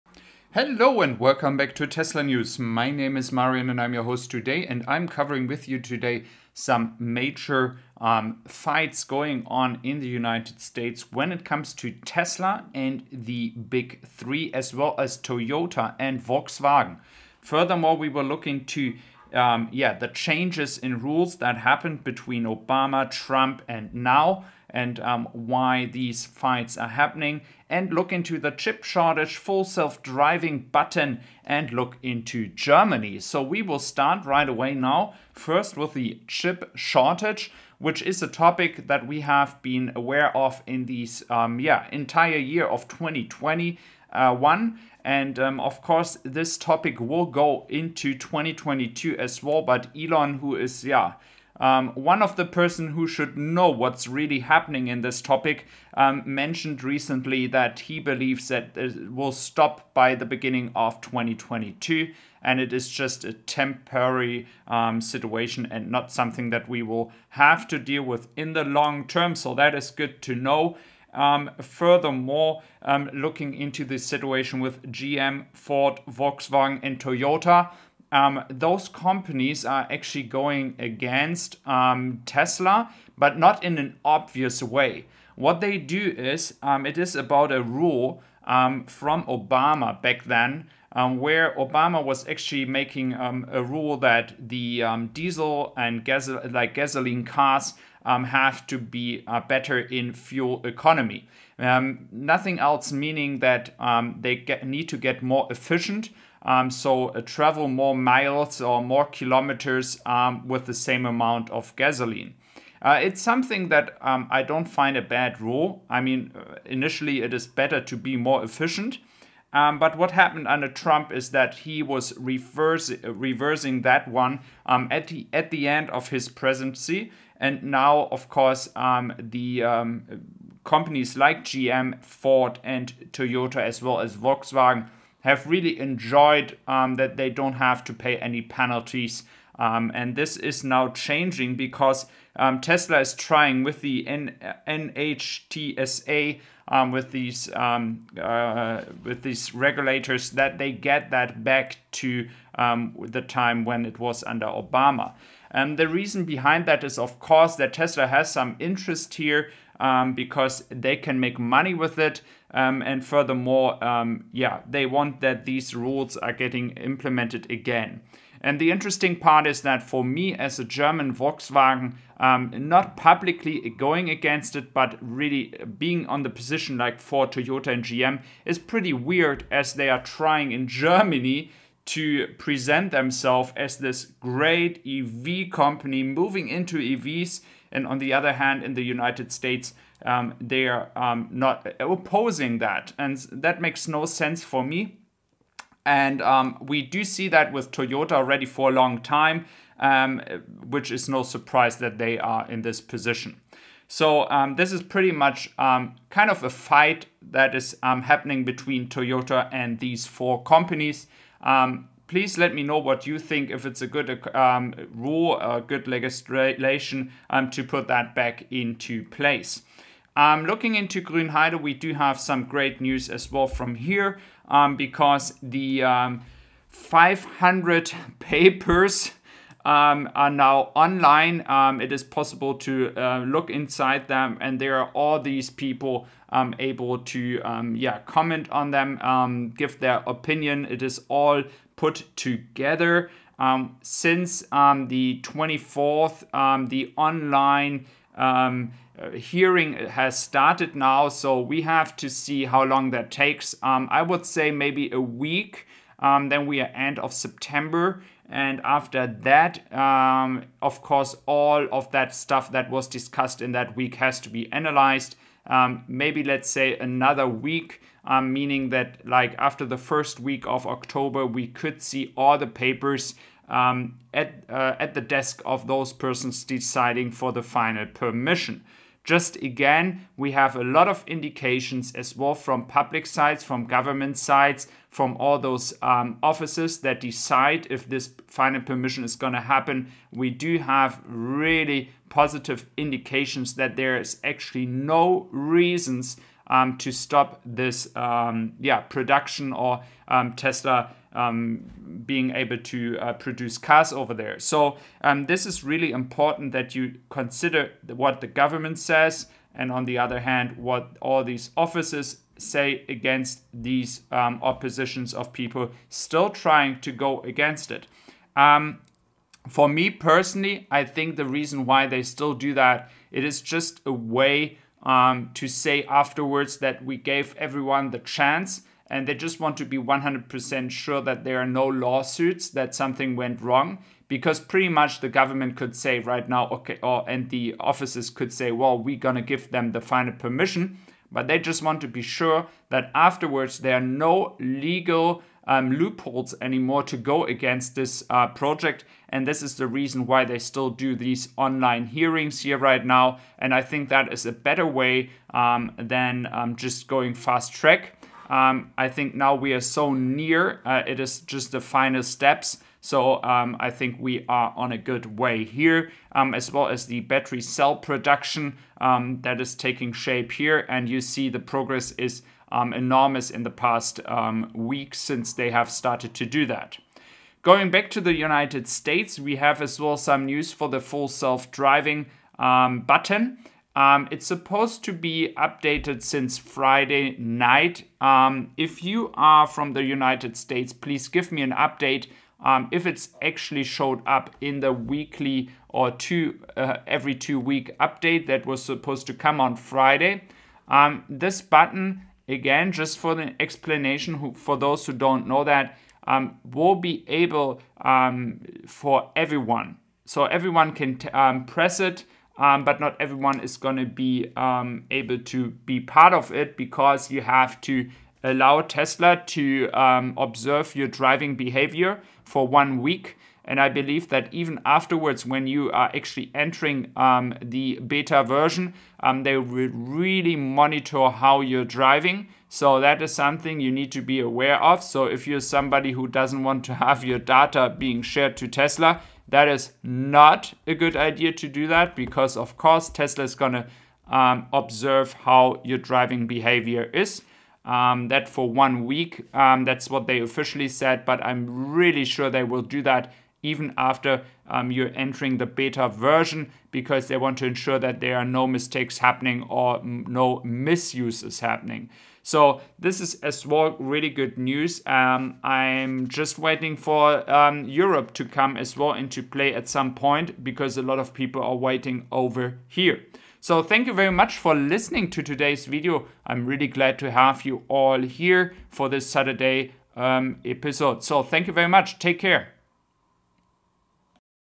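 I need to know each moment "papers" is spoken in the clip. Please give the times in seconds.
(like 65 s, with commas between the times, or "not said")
228 s, 272 s.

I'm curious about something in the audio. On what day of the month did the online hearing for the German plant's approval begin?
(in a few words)
24th.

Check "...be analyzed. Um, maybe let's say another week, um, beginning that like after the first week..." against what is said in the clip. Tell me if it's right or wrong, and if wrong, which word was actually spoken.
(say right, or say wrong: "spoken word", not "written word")
wrong: "meaning", not "beginning".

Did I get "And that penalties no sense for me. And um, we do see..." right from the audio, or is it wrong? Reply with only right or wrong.
wrong.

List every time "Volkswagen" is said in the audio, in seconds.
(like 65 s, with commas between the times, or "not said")
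16 s, 76 s, 134 s, 171 s.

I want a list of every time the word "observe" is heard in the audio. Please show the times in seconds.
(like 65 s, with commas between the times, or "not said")
420 s, 444 s.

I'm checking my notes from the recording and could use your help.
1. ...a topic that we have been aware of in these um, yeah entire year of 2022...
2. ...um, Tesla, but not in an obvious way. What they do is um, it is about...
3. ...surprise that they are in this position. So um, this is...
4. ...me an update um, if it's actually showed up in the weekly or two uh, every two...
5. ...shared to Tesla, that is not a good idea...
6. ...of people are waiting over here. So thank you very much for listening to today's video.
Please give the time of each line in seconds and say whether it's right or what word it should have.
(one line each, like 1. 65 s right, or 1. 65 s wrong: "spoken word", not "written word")
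1. 38 s wrong: "2021", not "2022"
2. 81 s right
3. 201 s right
4. 391 s right
5. 438 s right
6. 470 s right.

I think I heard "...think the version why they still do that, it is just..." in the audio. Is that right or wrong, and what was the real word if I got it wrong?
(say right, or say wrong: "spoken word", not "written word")
wrong: "reason", not "version".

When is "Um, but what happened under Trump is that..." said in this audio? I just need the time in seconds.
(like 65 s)
119 s.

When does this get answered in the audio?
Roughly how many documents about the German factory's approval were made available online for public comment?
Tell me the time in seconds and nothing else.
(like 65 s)
226 s.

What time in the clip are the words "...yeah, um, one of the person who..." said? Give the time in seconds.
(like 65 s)
50 s.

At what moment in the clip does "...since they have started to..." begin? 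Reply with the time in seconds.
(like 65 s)
374 s.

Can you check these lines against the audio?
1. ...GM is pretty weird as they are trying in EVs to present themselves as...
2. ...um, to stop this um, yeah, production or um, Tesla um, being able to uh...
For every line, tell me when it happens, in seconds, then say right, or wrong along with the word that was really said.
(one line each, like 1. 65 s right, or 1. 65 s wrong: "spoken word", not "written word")
1. 177 s wrong: "Germany", not "EVs"
2. 296 s right.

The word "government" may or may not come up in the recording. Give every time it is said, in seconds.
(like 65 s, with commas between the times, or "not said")
283 s, 308 s, 335 s.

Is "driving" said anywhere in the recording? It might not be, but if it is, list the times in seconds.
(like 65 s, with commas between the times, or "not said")
29 s, 381 s, 420 s, 431 s, 445 s.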